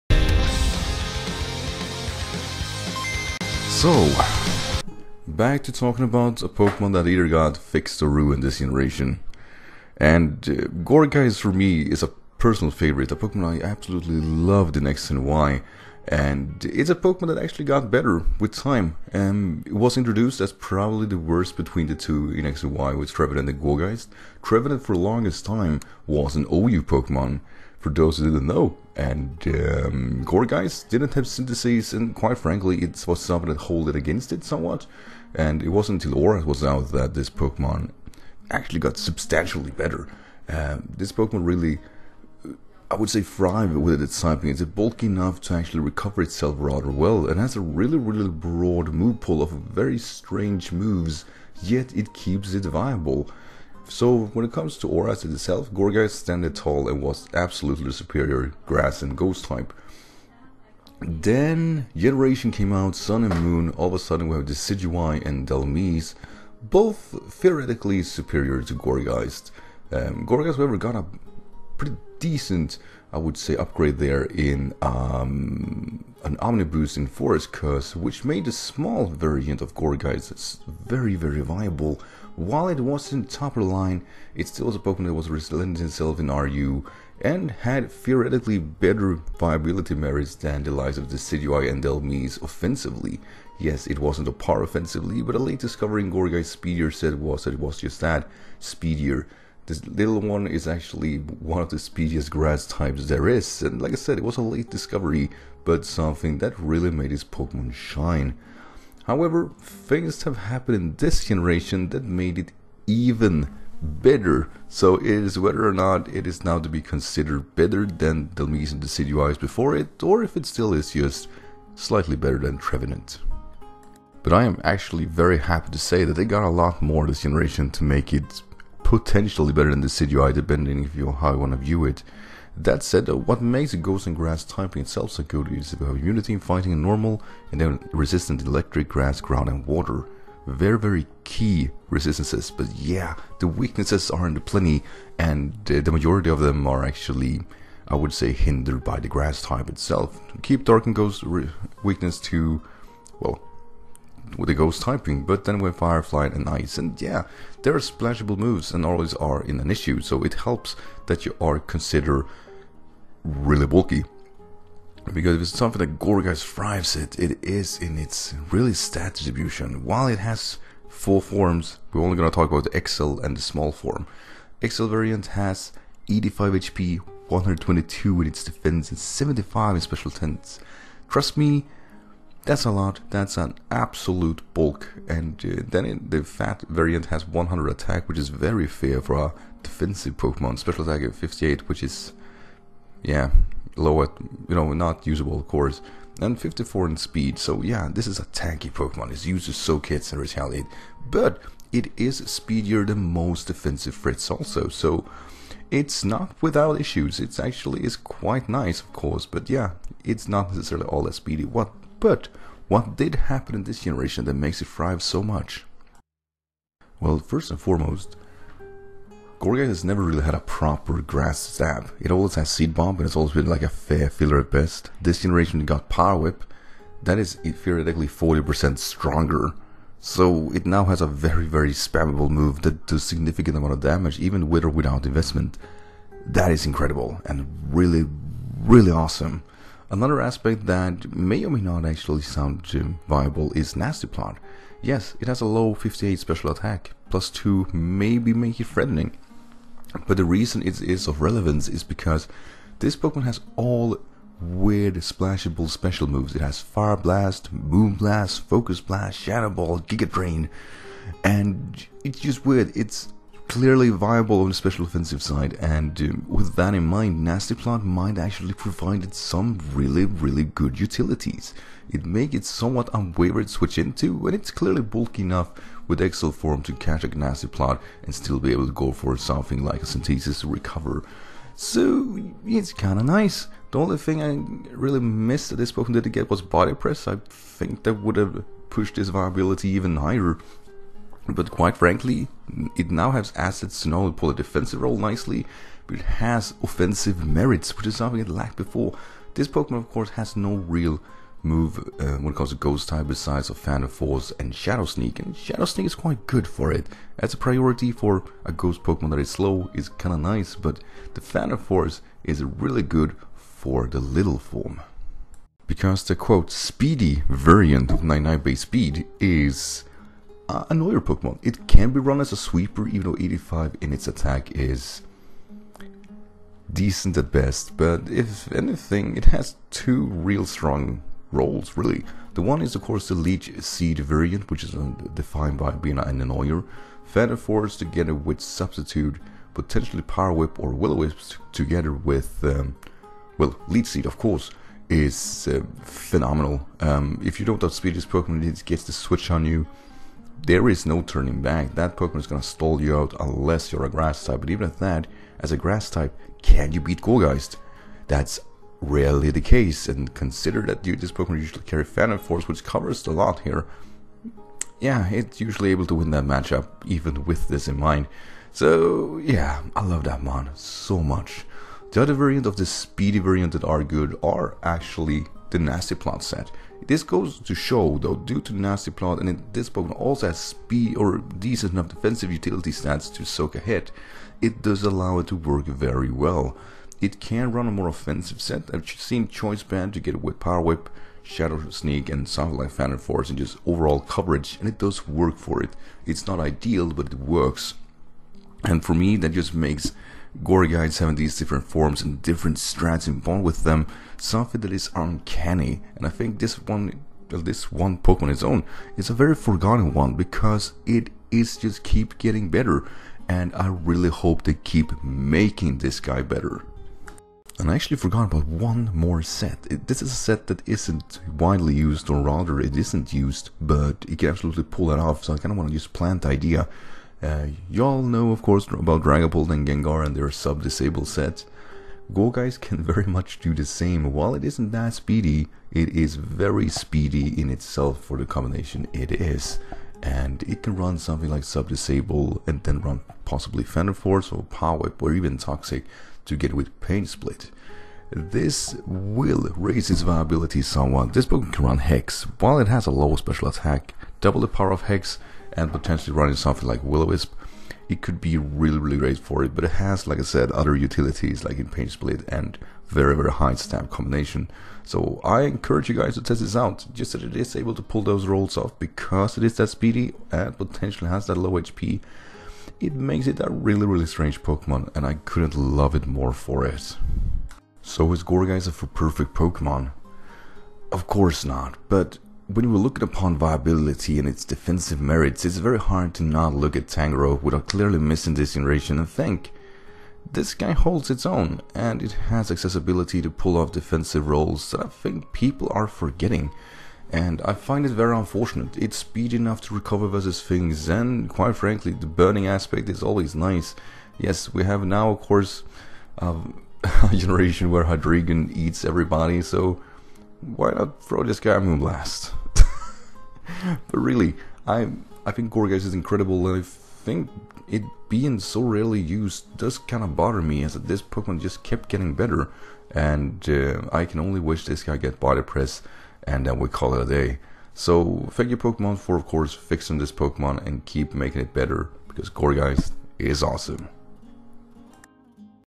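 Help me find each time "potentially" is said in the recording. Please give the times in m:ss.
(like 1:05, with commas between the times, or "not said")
2:08, 5:39, 7:35, 7:50.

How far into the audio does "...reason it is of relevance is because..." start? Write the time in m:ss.
4:10.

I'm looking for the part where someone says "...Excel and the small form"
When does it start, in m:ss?
2:52.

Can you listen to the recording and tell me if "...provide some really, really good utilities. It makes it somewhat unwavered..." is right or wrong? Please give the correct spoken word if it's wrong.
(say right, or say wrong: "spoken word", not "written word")
right.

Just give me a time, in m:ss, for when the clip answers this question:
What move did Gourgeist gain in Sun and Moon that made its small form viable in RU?
1:17.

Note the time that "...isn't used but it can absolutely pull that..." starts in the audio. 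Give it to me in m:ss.
7:02.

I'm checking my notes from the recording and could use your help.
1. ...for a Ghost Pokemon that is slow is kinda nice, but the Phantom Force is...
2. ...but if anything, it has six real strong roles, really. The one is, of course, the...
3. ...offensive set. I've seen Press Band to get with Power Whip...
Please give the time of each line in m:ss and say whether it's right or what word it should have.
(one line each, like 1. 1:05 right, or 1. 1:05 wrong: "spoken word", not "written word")
1. 5:07 right
2. 5:27 wrong: "two", not "six"
3. 6:27 wrong: "Choice", not "Press".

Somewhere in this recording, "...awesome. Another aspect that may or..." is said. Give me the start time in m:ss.
3:58.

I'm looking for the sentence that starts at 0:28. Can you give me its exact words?
And um, Gourgeist didn't have Synthesis, and quite frankly, it was something that held it against it somewhat.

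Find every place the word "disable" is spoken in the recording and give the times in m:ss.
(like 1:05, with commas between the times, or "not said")
7:10, 7:21.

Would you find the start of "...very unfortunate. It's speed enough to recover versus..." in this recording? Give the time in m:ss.
8:17.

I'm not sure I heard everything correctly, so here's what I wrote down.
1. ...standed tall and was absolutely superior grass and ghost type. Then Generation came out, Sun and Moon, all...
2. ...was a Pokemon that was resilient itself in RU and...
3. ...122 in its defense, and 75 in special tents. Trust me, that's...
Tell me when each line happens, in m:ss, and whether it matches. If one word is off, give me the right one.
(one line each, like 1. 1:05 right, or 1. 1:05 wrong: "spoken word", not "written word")
1. 0:56 right
2. 1:24 right
3. 2:57 right.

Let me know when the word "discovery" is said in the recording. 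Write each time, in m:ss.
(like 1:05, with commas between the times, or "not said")
1:35, 1:44.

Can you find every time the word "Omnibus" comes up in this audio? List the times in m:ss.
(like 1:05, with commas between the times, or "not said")
1:16.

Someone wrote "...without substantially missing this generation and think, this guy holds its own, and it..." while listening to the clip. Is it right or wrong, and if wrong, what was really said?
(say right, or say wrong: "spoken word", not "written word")
wrong: "clearly", not "substantially".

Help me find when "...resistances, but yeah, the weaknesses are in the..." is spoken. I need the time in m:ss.
2:21.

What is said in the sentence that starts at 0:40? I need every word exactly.
Um, this Pokemon really, I would say, thrive with its typing.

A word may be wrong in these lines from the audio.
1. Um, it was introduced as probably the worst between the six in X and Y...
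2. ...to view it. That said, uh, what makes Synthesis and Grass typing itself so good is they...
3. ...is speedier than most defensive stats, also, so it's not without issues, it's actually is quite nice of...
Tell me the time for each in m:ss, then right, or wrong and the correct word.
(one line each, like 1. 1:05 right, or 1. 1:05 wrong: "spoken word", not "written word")
1. 0:19 wrong: "two", not "six"
2. 2:11 wrong: "Ghost", not "Synthesis"
3. 3:21 wrong: "frits", not "stats".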